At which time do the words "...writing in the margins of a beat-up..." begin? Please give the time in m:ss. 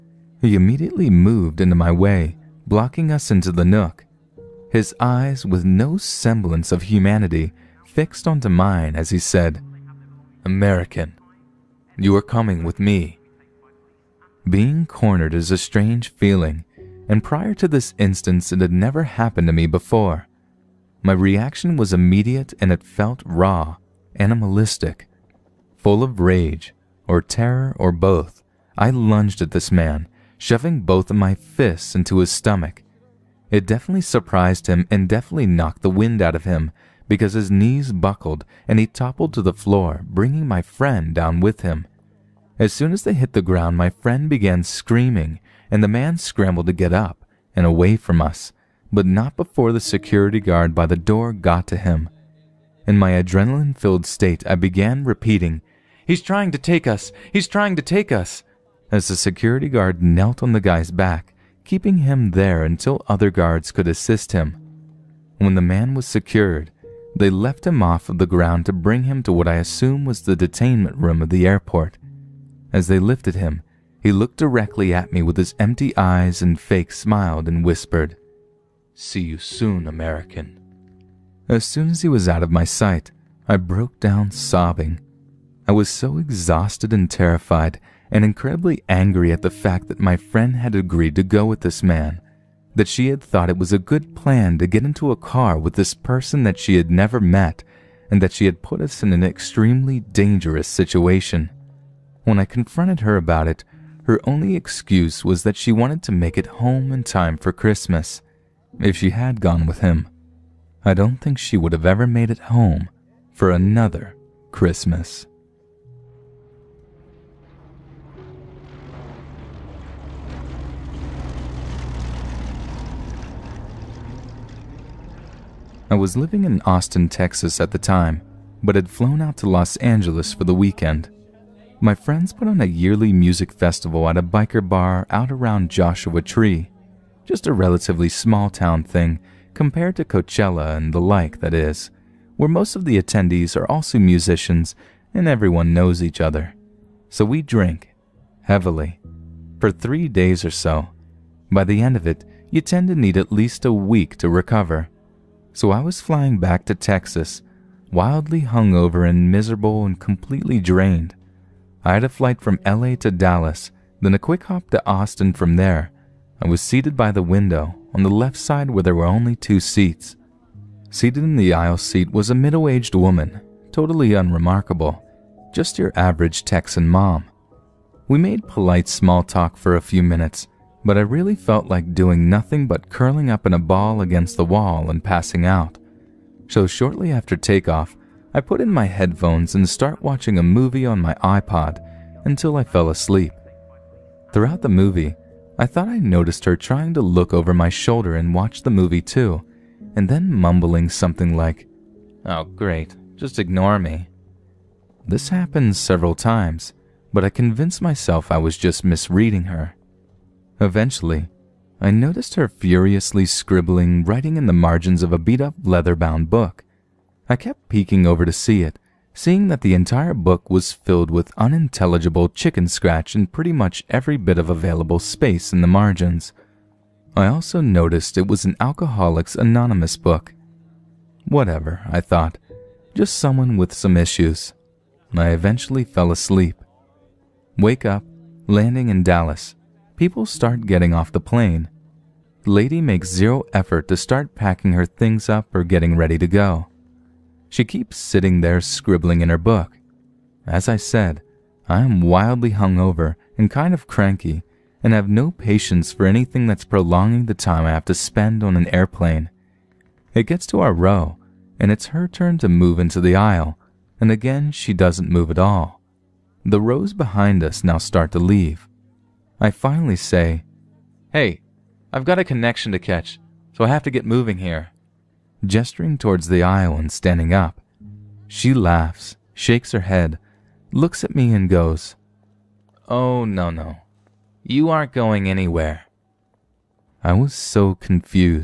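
3:34.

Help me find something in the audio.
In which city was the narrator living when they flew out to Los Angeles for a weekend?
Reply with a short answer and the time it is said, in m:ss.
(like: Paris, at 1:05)
Austin, Texas, at 2:06.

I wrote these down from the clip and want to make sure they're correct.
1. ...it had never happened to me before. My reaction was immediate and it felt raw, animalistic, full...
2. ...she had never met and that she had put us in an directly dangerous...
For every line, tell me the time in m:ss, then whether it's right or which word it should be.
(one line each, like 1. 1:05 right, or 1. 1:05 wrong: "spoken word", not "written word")
1. 0:18 right
2. 1:36 wrong: "extremely", not "directly".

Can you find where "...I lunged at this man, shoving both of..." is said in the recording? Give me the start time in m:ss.
0:28.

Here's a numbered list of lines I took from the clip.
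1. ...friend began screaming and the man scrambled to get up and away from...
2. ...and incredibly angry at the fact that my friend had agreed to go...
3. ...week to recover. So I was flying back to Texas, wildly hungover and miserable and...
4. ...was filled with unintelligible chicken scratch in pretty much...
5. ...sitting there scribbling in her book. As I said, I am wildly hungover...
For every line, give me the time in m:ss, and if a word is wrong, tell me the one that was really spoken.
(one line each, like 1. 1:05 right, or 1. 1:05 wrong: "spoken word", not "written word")
1. 0:43 right
2. 1:28 right
3. 2:33 right
4. 3:40 right
5. 4:07 right.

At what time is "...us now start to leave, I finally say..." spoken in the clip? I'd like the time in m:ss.
4:27.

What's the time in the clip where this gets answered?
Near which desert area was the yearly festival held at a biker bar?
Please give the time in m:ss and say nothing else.
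2:15.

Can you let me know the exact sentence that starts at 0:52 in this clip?
In my adrenaline filled state, I began repeating, He's trying to take us!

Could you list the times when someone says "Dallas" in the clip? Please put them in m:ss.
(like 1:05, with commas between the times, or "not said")
2:43, 3:59.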